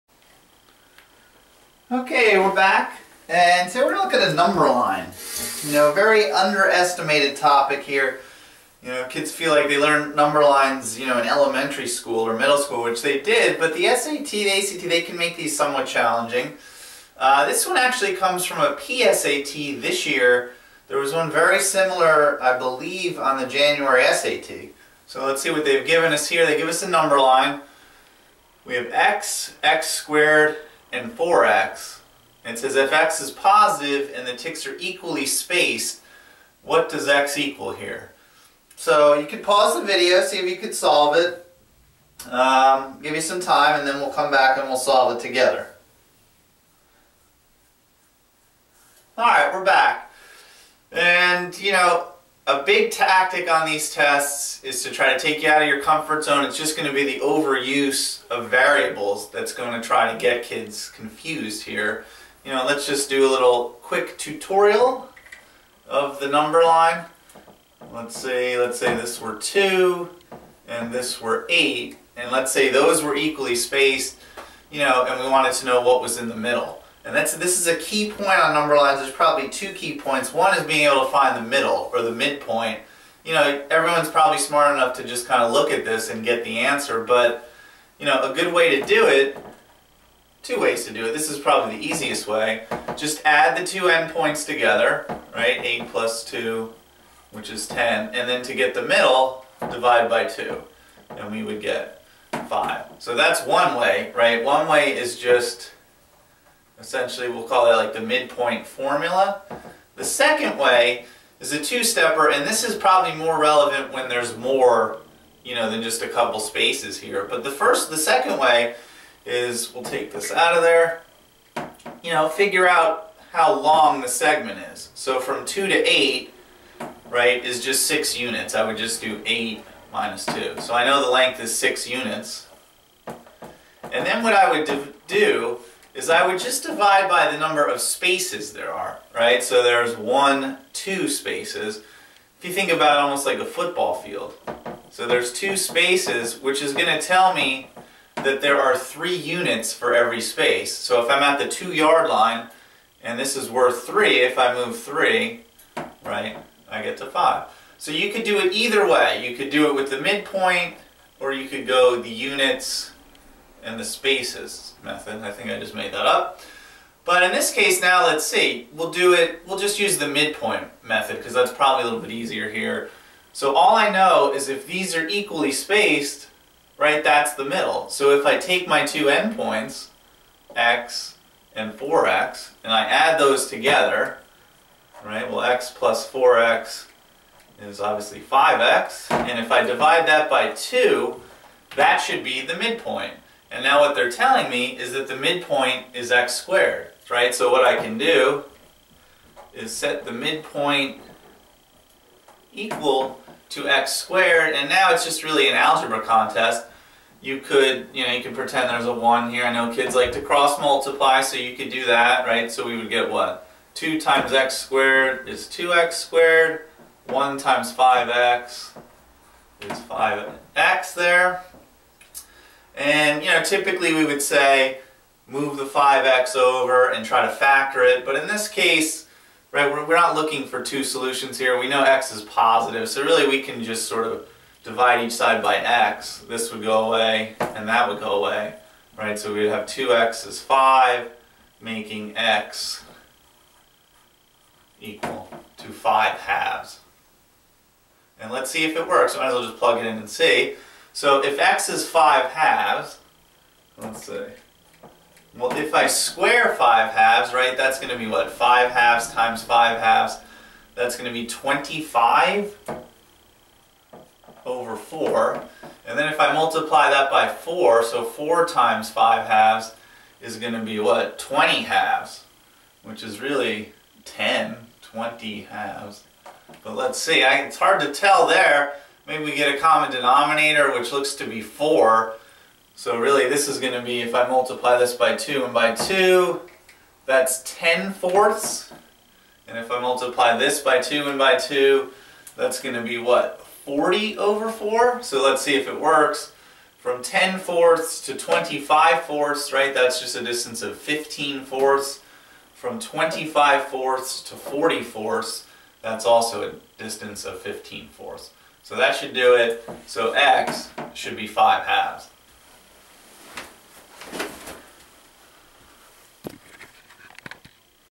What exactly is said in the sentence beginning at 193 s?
And now what they're telling me is that the midpoint is x squared, right?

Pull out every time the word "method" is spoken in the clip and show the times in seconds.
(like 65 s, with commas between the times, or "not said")
164 s, 170 s.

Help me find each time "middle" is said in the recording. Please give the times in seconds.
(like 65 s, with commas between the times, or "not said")
12 s, 76 s, 81 s, 98 s, 177 s.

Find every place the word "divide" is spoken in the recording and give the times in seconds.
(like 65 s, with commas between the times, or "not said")
99 s, 136 s, 189 s, 234 s.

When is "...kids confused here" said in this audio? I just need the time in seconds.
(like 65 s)
60 s.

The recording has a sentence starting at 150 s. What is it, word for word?
So if I'm at the two yard line, and this is worth three, if I move three, right, I get to five.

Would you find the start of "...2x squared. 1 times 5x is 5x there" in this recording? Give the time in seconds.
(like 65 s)
215 s.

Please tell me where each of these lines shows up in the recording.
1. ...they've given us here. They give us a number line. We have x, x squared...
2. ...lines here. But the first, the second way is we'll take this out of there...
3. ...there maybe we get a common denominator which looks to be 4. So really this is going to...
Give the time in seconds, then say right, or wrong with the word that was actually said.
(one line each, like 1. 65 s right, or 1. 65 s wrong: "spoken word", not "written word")
1. 25 s right
2. 116 s wrong: "spaces", not "lines"
3. 278 s right.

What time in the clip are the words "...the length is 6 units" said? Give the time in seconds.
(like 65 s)
131 s.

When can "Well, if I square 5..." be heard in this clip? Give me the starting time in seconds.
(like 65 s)
255 s.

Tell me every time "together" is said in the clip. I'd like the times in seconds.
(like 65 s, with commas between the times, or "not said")
45 s, 94 s, 183 s.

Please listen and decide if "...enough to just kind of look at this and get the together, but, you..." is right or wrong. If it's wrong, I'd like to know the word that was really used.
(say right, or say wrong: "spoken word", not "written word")
wrong: "answer", not "together".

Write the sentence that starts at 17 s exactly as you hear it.
Uh, this one actually comes from a PSAT this year.